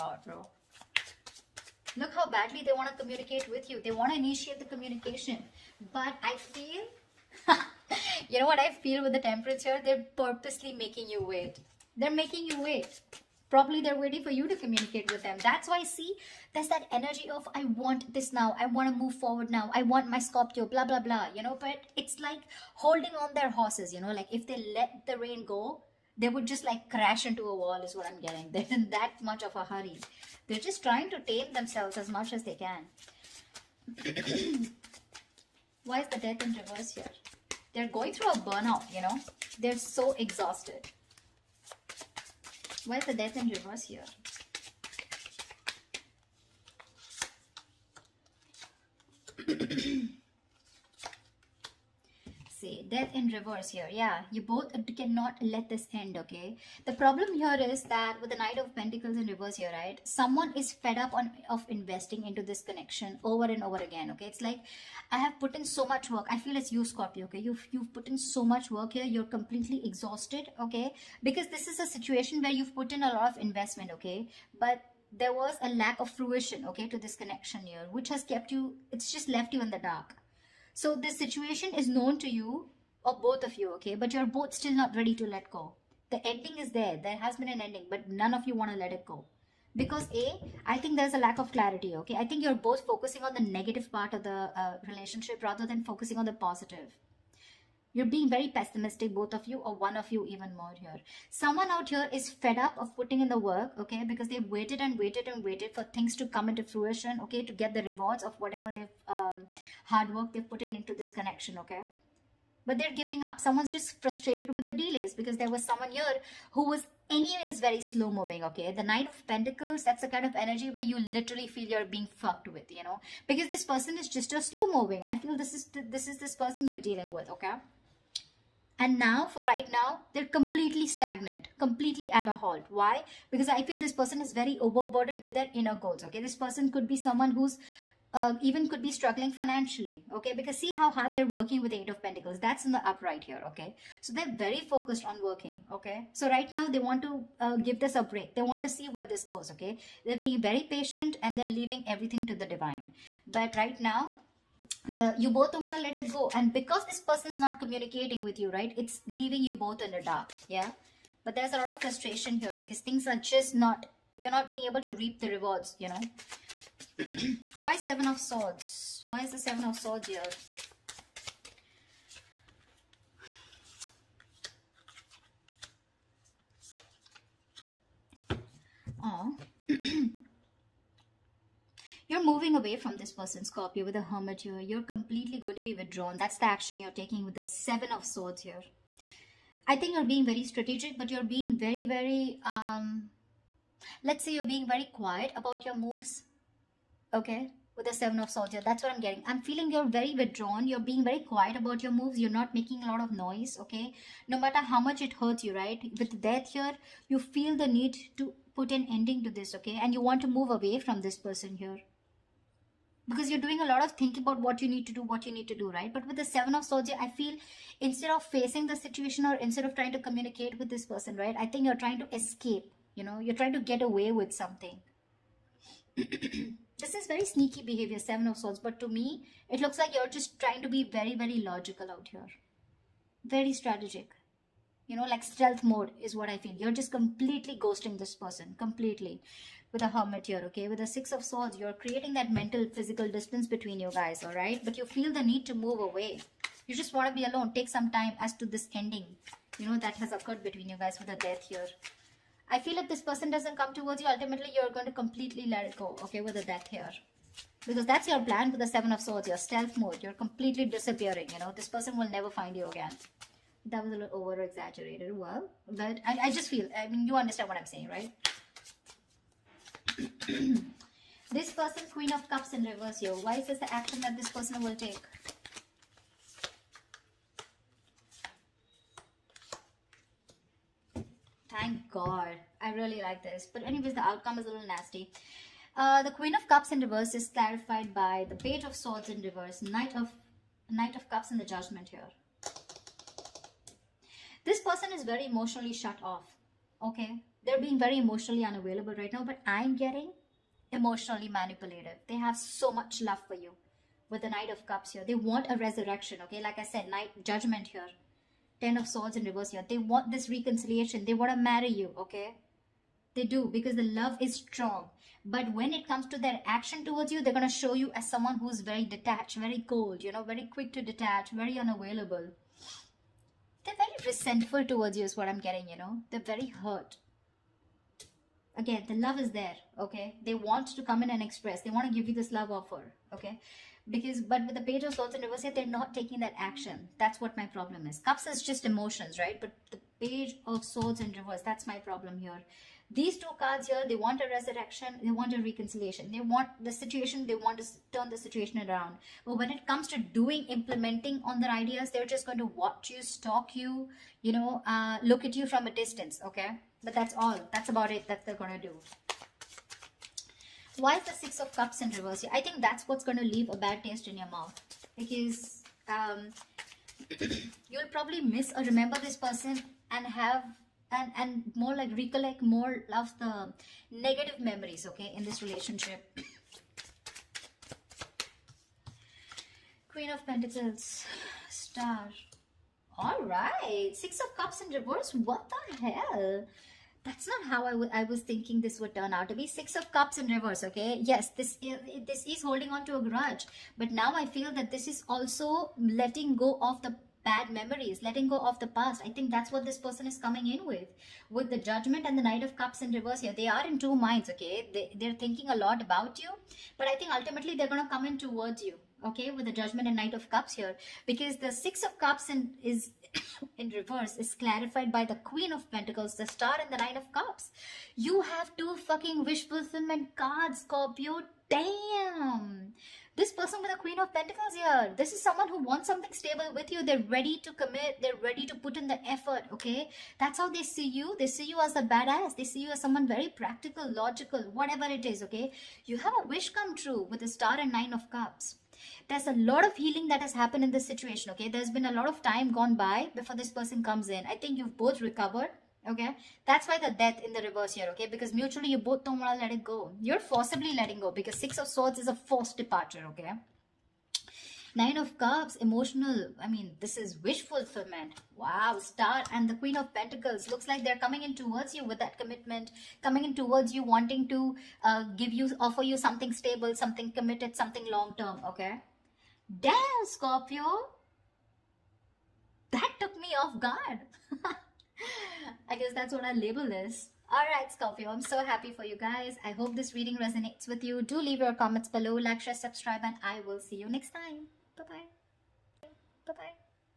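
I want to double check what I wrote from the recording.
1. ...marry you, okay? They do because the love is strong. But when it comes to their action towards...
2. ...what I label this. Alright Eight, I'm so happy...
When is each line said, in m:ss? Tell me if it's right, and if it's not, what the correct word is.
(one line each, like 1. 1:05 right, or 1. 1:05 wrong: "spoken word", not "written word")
1. 5:11 right
2. 7:56 wrong: "Scorpio", not "Eight".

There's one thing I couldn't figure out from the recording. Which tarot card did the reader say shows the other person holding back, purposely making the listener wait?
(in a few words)
Temperance.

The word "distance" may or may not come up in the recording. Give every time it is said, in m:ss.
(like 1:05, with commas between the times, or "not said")
4:03, 5:55.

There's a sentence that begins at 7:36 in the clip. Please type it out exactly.
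I mean, this is wish fulfillment.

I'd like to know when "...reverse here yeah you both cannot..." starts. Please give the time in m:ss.
0:53.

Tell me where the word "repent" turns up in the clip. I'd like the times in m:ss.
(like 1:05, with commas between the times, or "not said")
not said.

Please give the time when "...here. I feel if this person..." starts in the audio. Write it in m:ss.
4:11.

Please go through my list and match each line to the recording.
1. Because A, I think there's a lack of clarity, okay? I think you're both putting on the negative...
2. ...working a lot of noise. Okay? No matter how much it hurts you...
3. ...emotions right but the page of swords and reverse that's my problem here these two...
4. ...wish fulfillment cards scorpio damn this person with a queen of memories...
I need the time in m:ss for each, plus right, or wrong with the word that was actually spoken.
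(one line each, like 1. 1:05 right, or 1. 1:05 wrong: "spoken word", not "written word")
1. 1:29 wrong: "focusing", not "putting"
2. 3:22 wrong: "making", not "working"
3. 5:38 right
4. 6:59 wrong: "pentacles", not "memories".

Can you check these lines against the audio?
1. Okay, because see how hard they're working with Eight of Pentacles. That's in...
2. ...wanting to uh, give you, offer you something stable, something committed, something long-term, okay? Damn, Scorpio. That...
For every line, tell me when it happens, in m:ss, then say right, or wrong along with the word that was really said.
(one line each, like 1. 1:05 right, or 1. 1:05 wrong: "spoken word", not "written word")
1. 2:20 right
2. 7:43 right.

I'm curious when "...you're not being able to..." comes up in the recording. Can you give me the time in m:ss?
2:44.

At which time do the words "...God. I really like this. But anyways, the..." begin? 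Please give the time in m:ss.
4:41.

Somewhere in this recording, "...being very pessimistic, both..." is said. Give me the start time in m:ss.
1:38.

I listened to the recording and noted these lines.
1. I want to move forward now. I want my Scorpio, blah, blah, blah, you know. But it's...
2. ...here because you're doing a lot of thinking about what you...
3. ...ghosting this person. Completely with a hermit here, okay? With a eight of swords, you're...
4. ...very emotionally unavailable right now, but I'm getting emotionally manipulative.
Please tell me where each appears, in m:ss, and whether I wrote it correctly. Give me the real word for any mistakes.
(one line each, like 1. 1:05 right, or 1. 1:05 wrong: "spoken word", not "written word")
1. 0:18 right
2. 3:31 right
3. 3:57 wrong: "six", not "eight"
4. 4:57 right.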